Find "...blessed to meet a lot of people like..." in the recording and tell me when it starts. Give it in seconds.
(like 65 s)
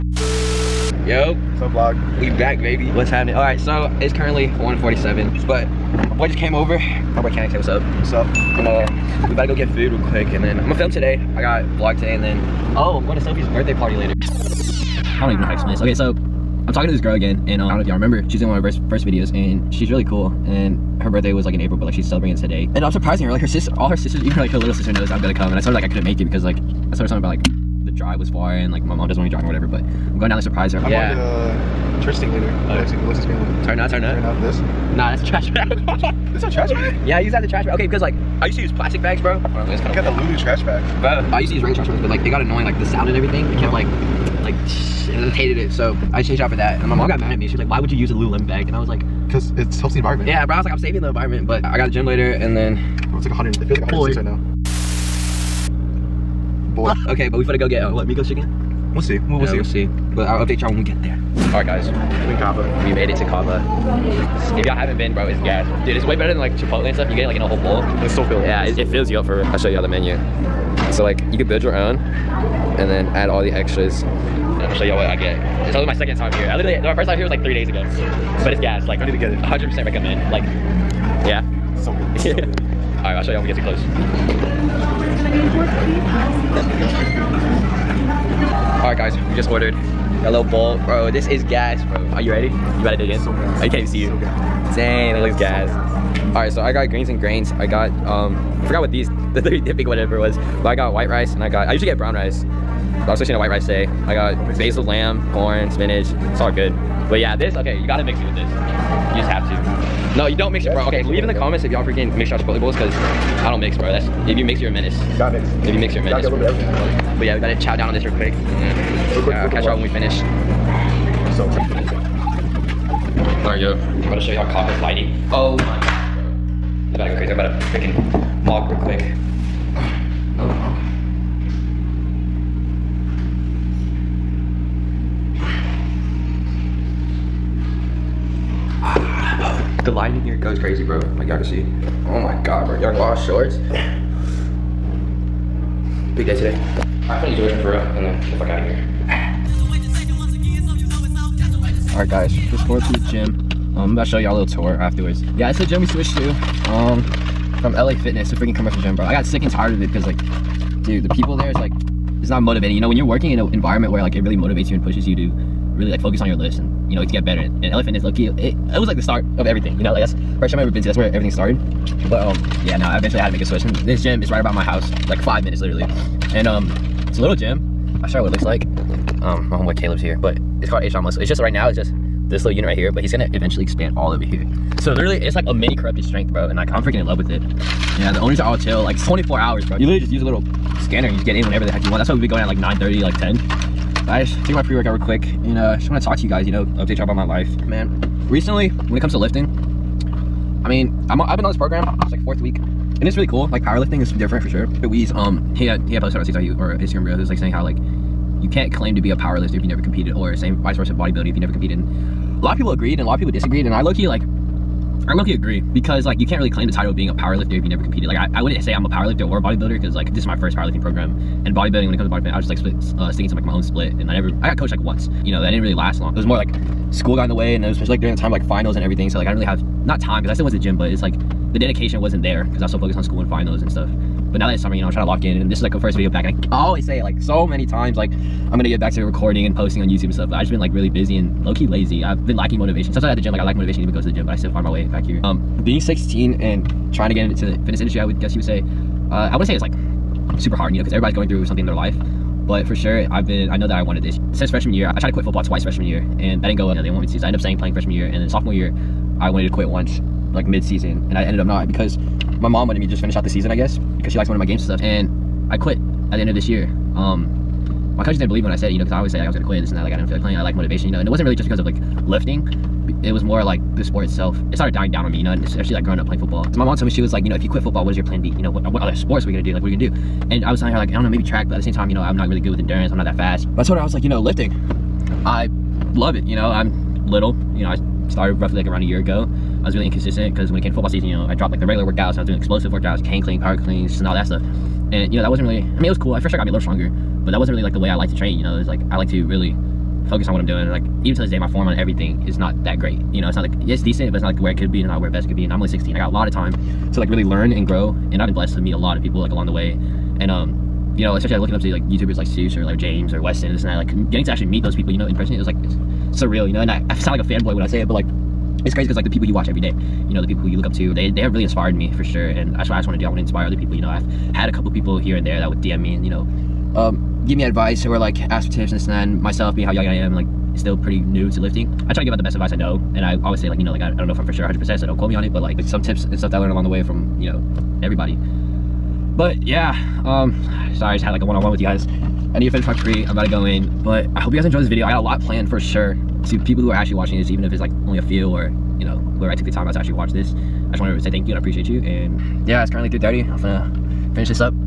308 s.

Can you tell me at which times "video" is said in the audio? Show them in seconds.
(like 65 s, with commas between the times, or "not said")
19 s, 235 s, 344 s.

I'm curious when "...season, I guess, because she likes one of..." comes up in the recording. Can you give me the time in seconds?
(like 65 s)
263 s.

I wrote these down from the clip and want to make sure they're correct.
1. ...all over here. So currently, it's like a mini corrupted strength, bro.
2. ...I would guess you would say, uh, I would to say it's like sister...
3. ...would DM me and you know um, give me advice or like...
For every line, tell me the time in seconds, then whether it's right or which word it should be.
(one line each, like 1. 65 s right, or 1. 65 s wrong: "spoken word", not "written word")
1. 183 s wrong: "literally", not "currently"
2. 248 s wrong: "super", not "sister"
3. 325 s right.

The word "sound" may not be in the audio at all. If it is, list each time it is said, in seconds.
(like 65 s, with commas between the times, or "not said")
42 s, 316 s.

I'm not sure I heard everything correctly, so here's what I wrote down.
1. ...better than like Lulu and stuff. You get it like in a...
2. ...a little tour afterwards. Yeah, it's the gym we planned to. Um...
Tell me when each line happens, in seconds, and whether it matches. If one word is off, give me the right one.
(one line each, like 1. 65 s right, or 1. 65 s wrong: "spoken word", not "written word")
1. 66 s wrong: "Chipotle", not "Lulu"
2. 154 s wrong: "switched", not "planned".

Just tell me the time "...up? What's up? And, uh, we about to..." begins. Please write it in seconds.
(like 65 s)
7 s.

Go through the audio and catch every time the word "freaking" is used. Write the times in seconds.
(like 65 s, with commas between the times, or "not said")
111 s, 127 s, 158 s, 186 s.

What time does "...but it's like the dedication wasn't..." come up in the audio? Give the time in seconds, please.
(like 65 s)
230 s.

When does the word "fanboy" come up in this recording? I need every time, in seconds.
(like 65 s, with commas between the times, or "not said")
317 s.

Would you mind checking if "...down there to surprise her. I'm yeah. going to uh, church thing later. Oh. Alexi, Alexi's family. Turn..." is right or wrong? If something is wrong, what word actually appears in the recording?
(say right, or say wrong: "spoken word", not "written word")
right.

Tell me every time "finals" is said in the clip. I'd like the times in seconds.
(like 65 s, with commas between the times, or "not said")
228 s, 233 s.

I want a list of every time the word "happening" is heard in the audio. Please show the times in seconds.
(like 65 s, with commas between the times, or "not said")
3 s.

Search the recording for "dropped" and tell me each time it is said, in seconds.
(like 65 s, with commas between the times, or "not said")
291 s.